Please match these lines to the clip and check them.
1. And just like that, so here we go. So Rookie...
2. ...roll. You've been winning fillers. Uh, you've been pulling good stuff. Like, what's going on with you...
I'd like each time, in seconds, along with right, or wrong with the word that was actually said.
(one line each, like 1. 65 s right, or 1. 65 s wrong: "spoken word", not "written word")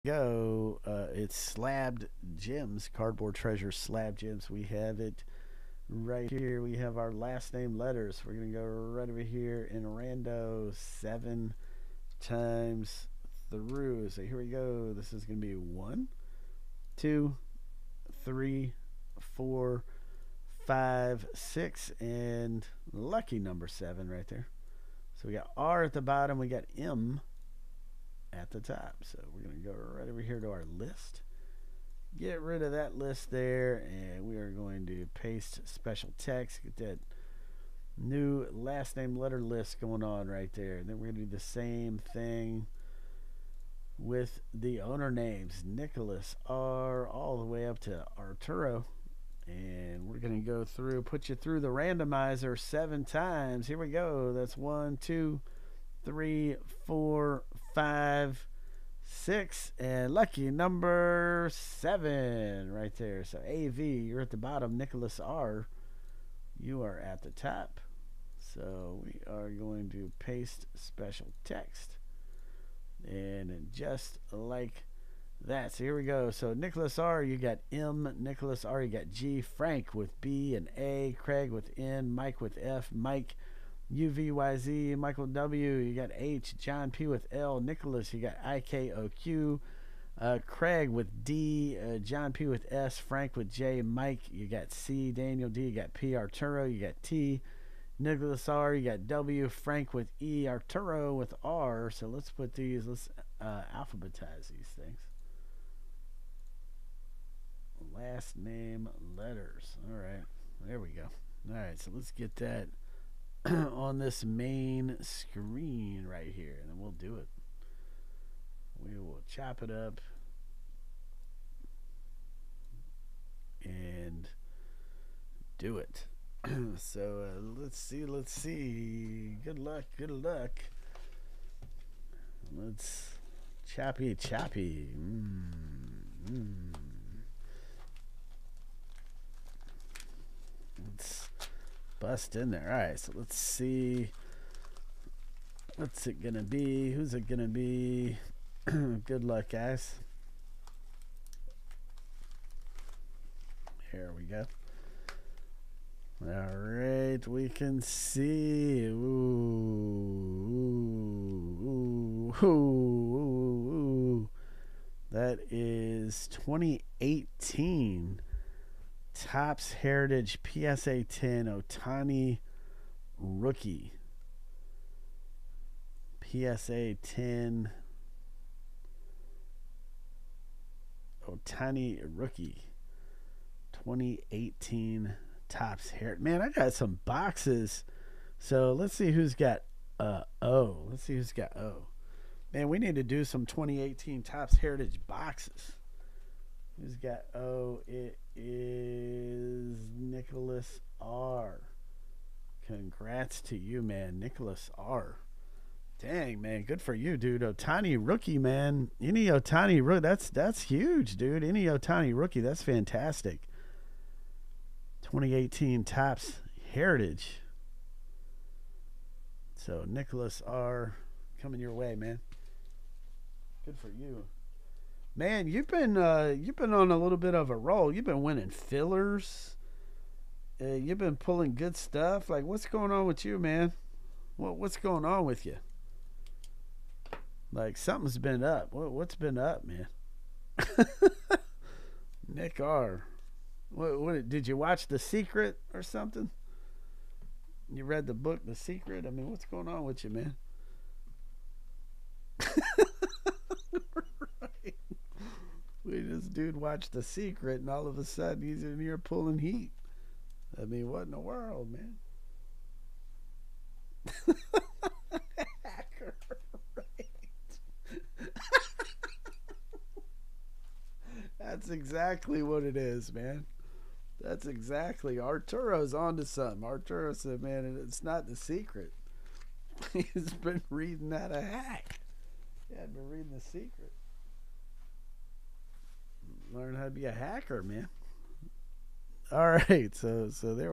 1. 73 s wrong: "Nicholas", not "Rookie"
2. 227 s right.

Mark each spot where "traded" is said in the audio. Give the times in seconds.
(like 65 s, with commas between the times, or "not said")
not said.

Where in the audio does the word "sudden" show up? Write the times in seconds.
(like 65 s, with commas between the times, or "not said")
258 s.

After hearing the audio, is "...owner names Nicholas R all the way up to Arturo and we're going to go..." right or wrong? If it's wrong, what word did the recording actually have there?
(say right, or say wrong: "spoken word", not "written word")
right.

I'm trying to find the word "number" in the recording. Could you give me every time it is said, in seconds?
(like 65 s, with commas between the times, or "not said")
23 s, 60 s.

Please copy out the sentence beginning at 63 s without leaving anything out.
So AV, you're at the bottom.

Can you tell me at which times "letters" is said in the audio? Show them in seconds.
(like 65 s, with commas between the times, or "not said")
7 s, 39 s, 109 s.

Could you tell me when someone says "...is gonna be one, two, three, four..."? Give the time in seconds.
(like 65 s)
15 s.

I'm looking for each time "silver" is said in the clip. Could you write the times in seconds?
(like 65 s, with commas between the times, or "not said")
not said.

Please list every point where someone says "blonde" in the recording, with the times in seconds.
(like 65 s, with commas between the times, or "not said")
not said.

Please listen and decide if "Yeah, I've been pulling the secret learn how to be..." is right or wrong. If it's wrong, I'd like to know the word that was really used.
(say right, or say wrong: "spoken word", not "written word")
wrong: "reading", not "pulling".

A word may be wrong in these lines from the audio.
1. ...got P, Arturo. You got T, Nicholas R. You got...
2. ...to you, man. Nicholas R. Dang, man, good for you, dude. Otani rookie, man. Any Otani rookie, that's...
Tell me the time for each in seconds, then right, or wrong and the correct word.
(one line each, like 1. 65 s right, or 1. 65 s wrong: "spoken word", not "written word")
1. 95 s right
2. 203 s right.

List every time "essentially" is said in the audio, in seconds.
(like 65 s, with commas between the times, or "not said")
not said.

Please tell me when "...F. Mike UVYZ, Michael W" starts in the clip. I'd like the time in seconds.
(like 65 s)
82 s.